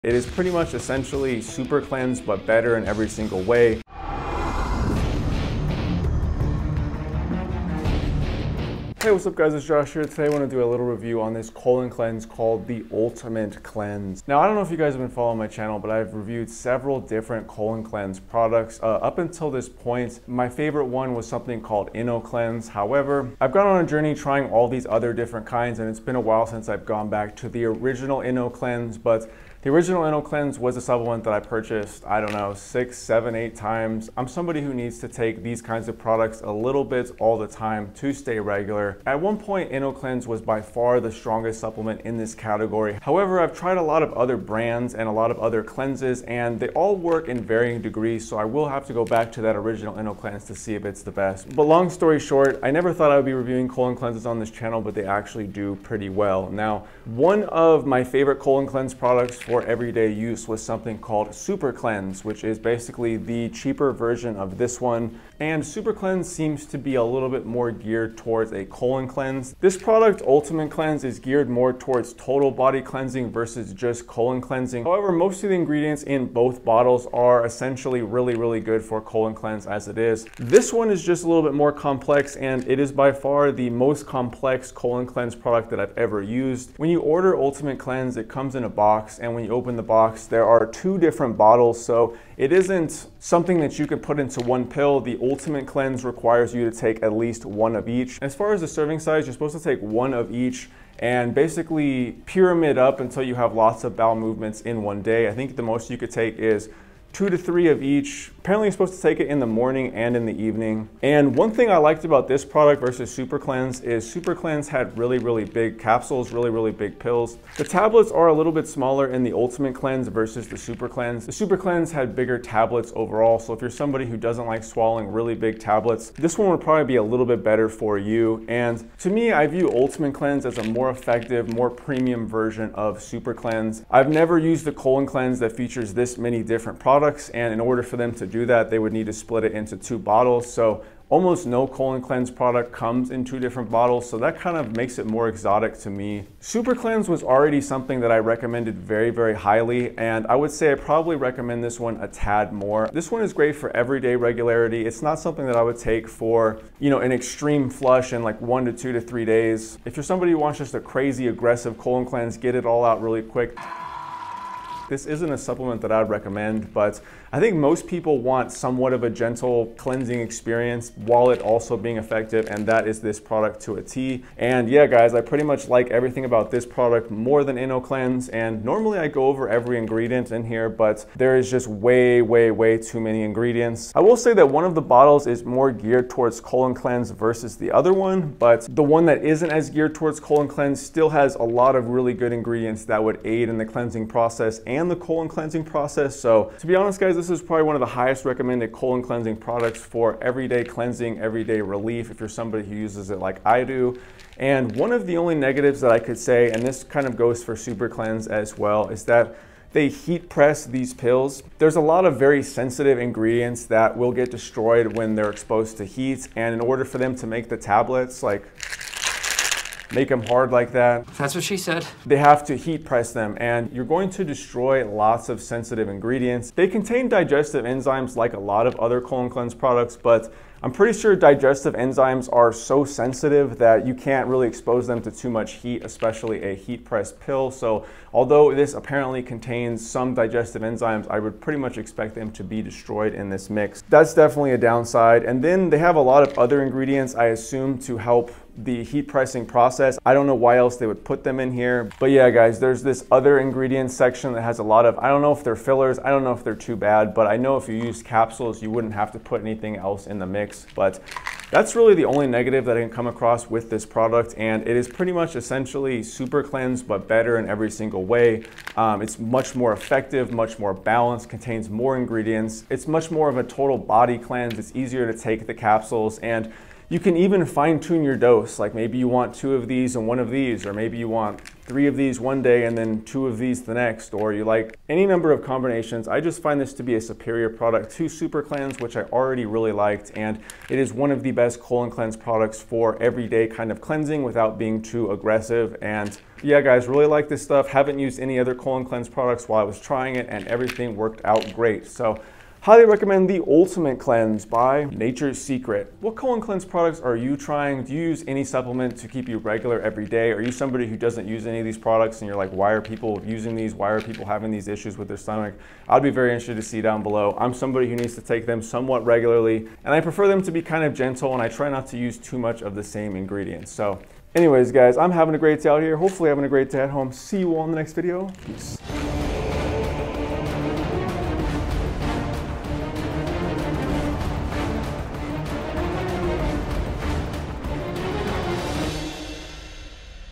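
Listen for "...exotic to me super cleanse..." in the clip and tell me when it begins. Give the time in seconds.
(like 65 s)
145 s.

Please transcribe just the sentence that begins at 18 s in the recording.
Uh, up until this point, my favorite one was something called Inno Cleanse.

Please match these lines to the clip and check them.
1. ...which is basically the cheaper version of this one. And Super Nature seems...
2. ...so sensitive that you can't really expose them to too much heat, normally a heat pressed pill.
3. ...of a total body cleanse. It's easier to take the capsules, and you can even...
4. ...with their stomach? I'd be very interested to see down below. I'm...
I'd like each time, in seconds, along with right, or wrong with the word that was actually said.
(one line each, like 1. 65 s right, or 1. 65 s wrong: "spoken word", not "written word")
1. 62 s wrong: "Cleanse", not "Nature"
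2. 232 s wrong: "especially", not "normally"
3. 273 s right
4. 314 s right.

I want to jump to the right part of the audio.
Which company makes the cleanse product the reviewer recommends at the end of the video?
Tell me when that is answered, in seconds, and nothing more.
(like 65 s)
304 s.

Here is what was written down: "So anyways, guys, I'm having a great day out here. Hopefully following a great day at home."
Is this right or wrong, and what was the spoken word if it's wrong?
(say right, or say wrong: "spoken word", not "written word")
wrong: "having", not "following".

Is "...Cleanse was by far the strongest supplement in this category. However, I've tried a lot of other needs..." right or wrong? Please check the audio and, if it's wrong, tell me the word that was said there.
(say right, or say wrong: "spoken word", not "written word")
wrong: "brands", not "needs".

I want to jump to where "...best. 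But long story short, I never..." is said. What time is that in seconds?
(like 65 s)
51 s.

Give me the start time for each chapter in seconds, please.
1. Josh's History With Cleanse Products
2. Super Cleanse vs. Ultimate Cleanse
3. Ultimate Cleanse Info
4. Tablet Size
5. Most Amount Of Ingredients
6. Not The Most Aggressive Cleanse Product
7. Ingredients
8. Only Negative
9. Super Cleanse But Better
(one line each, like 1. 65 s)
1. 14 s
2. 57 s
3. 88 s
4. 110 s
5. 133 s
6. 150 s
7. 178 s
8. 203 s
9. 264 s.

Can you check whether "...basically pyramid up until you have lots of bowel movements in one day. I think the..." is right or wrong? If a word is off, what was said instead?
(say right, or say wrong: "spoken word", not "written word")
right.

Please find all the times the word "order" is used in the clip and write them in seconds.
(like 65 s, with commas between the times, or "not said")
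87 s, 137 s, 216 s.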